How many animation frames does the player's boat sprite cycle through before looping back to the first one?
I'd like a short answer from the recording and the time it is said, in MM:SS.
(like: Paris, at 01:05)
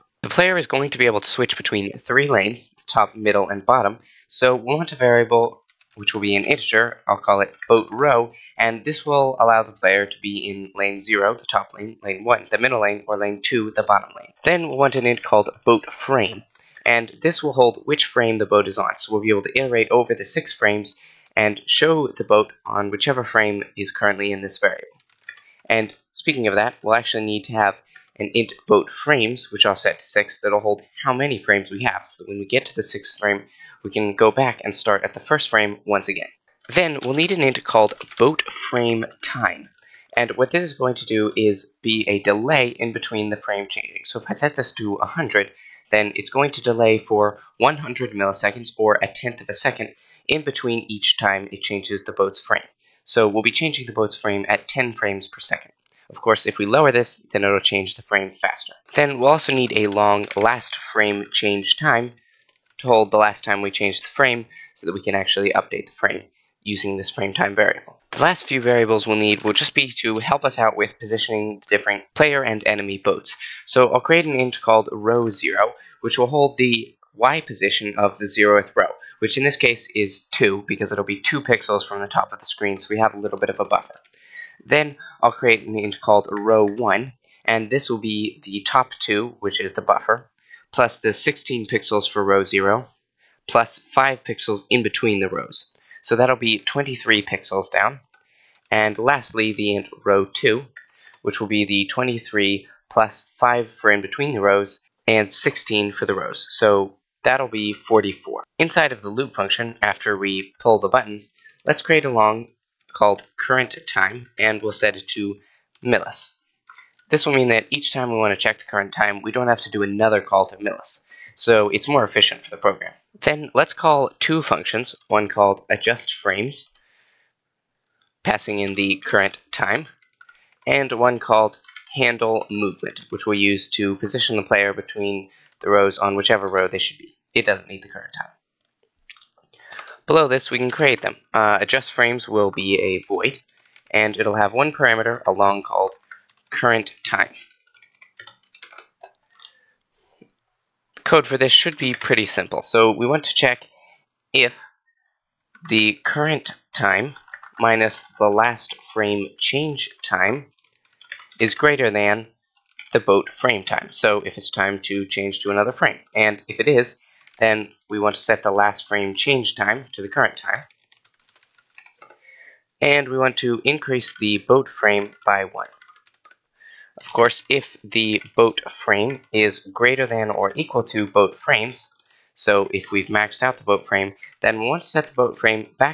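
6, at 00:30.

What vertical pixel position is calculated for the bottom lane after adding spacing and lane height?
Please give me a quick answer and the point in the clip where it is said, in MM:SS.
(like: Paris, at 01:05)
44, at 01:47.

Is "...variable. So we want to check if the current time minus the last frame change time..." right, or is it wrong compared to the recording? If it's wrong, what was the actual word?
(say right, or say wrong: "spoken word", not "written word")
wrong: "simple", not "variable".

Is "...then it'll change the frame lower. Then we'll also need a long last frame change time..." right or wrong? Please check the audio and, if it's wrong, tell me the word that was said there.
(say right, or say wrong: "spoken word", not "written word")
wrong: "faster", not "lower".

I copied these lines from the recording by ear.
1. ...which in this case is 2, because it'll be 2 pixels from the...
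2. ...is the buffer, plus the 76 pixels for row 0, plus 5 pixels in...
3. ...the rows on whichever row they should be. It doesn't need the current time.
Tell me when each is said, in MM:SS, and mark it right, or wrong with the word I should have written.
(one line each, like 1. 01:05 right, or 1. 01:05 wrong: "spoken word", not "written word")
1. 01:19 right
2. 01:29 wrong: "16", not "76"
3. 02:15 right.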